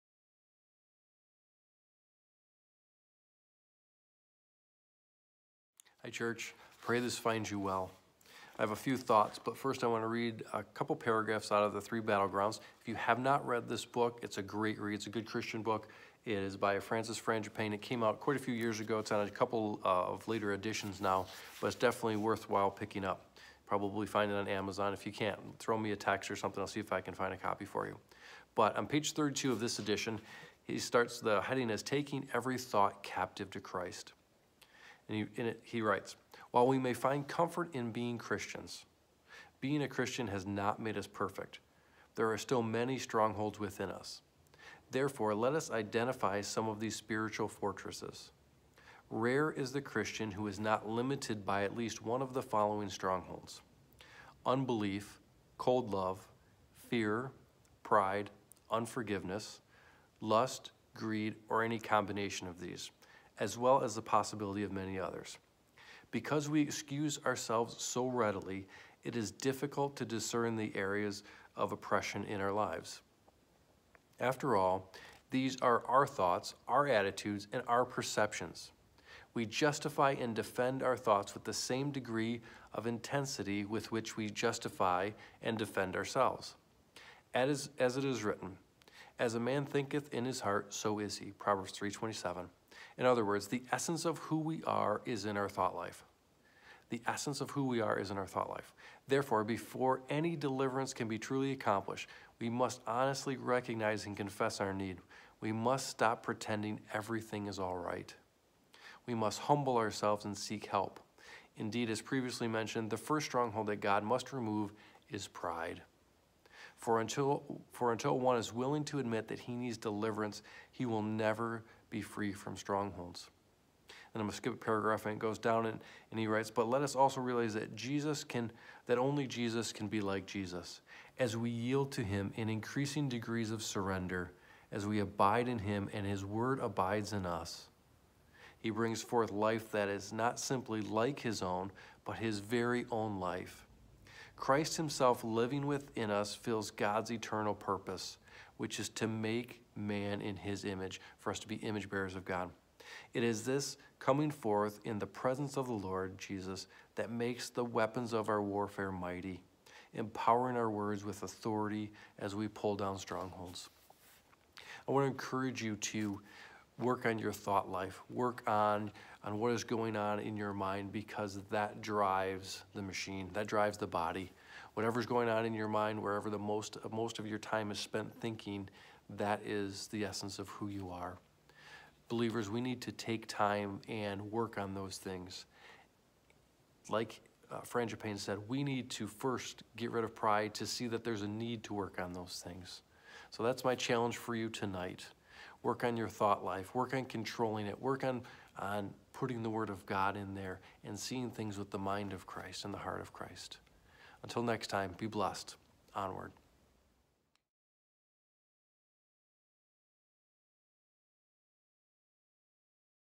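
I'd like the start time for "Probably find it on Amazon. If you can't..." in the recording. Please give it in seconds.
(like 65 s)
23 s.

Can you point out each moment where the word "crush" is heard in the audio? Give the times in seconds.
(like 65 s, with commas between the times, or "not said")
not said.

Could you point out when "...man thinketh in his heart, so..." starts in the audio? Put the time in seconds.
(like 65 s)
89 s.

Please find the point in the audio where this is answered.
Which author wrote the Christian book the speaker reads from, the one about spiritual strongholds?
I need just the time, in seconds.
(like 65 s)
16 s.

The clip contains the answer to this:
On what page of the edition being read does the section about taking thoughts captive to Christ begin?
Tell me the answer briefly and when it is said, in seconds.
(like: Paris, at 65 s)
32, at 29 s.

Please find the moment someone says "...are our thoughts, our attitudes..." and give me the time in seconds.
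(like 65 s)
75 s.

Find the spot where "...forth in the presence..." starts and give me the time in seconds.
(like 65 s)
154 s.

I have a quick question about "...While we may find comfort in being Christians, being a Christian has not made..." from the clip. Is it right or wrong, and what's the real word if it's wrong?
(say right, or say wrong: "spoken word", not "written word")
right.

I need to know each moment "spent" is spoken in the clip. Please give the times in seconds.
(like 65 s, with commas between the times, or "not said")
177 s.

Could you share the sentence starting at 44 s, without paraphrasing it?
Therefore, let us identify some of these spiritual fortresses.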